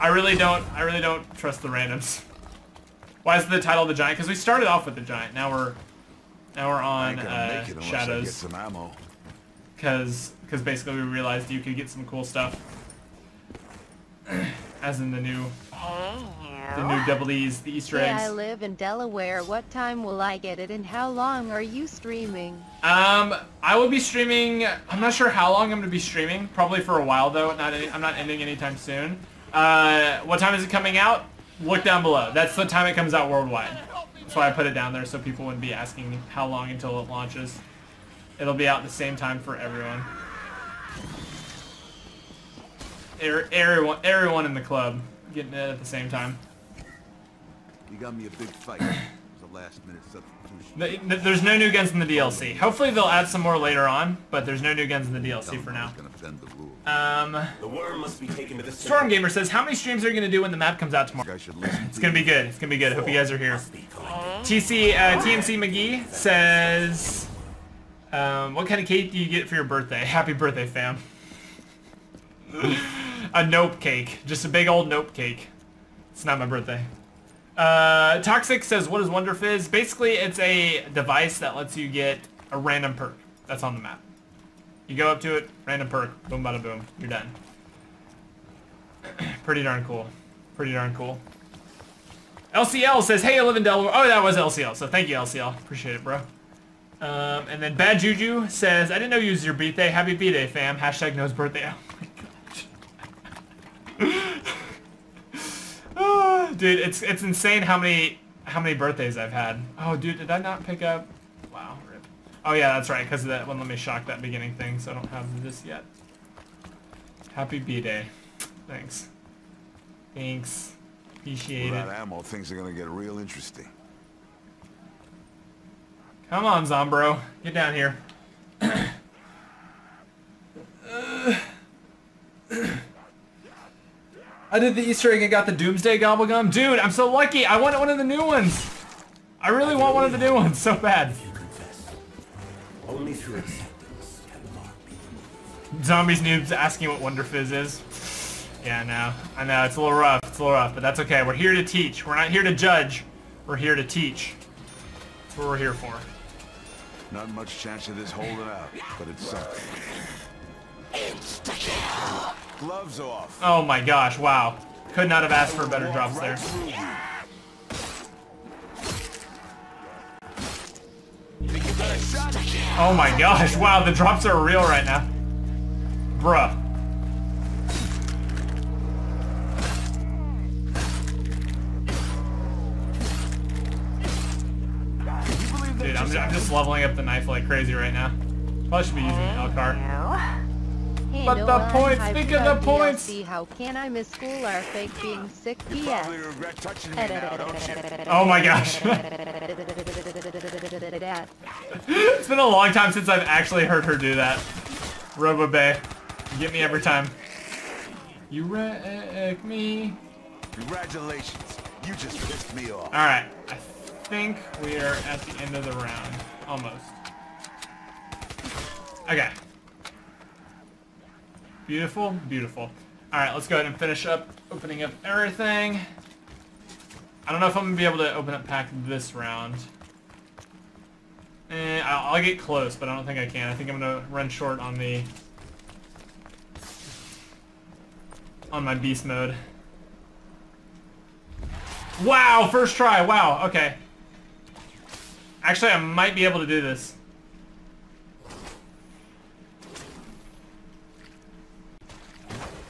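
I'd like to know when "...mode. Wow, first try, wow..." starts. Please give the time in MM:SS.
03:59.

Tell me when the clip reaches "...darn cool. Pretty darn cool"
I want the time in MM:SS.
01:29.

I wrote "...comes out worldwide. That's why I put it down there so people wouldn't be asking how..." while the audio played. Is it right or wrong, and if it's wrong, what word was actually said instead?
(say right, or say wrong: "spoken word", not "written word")
right.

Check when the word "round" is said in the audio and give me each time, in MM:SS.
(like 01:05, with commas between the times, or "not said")
03:35, 03:49.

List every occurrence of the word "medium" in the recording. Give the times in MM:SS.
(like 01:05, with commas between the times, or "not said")
not said.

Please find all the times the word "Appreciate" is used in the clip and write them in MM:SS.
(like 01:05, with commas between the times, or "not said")
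01:35, 02:01.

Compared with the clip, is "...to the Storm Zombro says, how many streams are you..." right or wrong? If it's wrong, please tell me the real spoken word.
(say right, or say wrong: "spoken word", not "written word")
wrong: "Gamer", not "Zombro".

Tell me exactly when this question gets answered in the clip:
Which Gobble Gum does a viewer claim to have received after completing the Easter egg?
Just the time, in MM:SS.
02:15.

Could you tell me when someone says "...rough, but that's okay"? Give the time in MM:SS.
02:30.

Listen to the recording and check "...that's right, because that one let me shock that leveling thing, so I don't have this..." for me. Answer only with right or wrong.
wrong.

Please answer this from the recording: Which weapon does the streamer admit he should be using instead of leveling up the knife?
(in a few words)
L-CAR.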